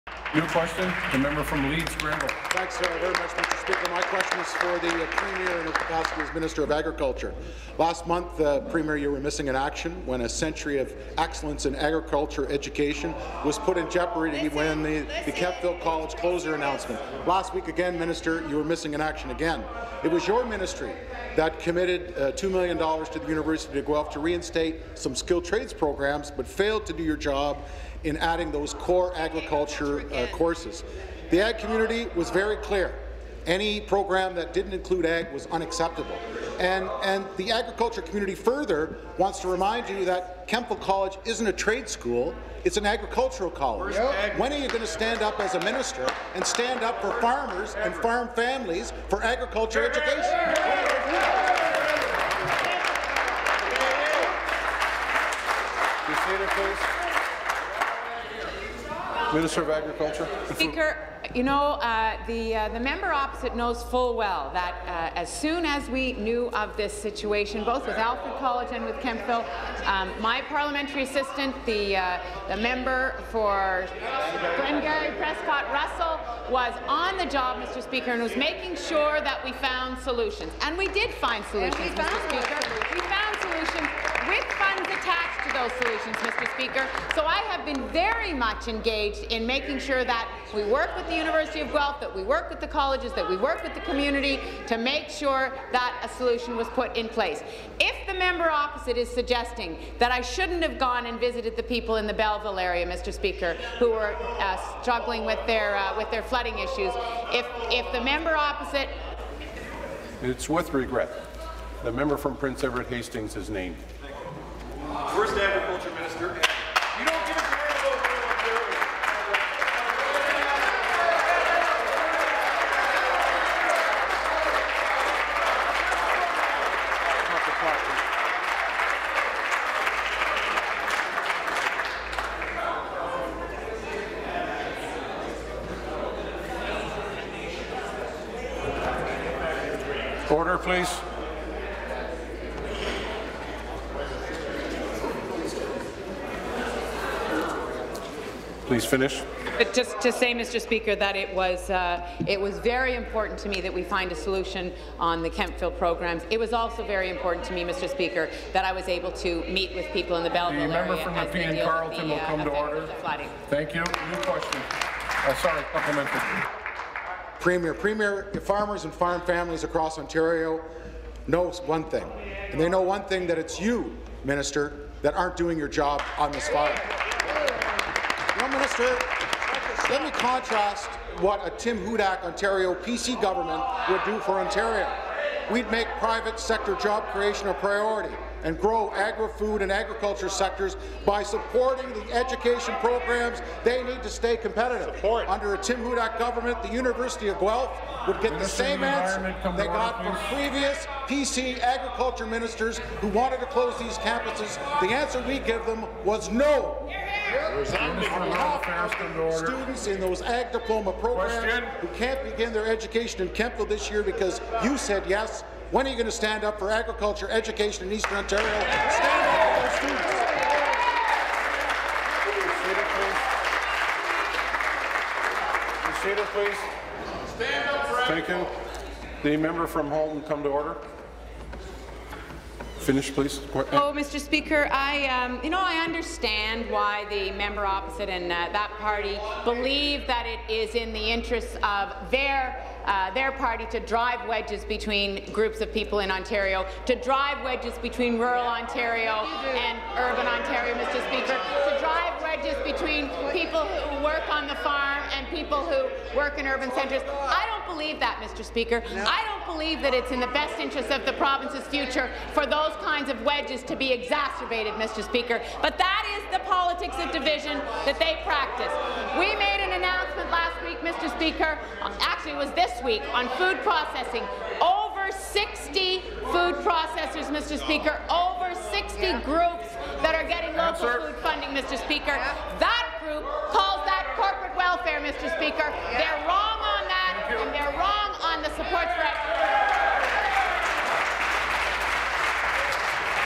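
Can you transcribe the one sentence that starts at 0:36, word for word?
And, and the agriculture community further wants to remind you that Kemptville College isn't a trade school, it's an agricultural college.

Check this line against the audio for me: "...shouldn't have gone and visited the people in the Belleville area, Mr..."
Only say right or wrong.
right.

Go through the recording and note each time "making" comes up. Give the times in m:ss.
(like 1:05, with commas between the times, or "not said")
1:18, 1:29.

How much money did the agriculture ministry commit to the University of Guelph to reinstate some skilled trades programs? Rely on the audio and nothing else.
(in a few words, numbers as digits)
$2 million.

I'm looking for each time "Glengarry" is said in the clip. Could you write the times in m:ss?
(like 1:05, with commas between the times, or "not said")
1:14.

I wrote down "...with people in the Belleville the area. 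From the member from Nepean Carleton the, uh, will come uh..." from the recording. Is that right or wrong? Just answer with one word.
right.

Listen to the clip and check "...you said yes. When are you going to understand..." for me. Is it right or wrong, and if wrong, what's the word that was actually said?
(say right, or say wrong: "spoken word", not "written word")
wrong: "stand", not "understand".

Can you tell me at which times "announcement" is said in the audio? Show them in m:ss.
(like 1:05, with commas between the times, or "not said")
0:16, 4:29.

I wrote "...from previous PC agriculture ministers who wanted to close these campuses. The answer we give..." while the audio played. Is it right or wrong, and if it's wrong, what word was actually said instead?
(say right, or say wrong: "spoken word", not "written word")
right.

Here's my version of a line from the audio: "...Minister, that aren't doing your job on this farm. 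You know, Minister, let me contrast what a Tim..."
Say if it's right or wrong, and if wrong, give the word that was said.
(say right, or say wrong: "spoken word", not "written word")
right.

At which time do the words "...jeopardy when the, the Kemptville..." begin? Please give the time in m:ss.
0:13.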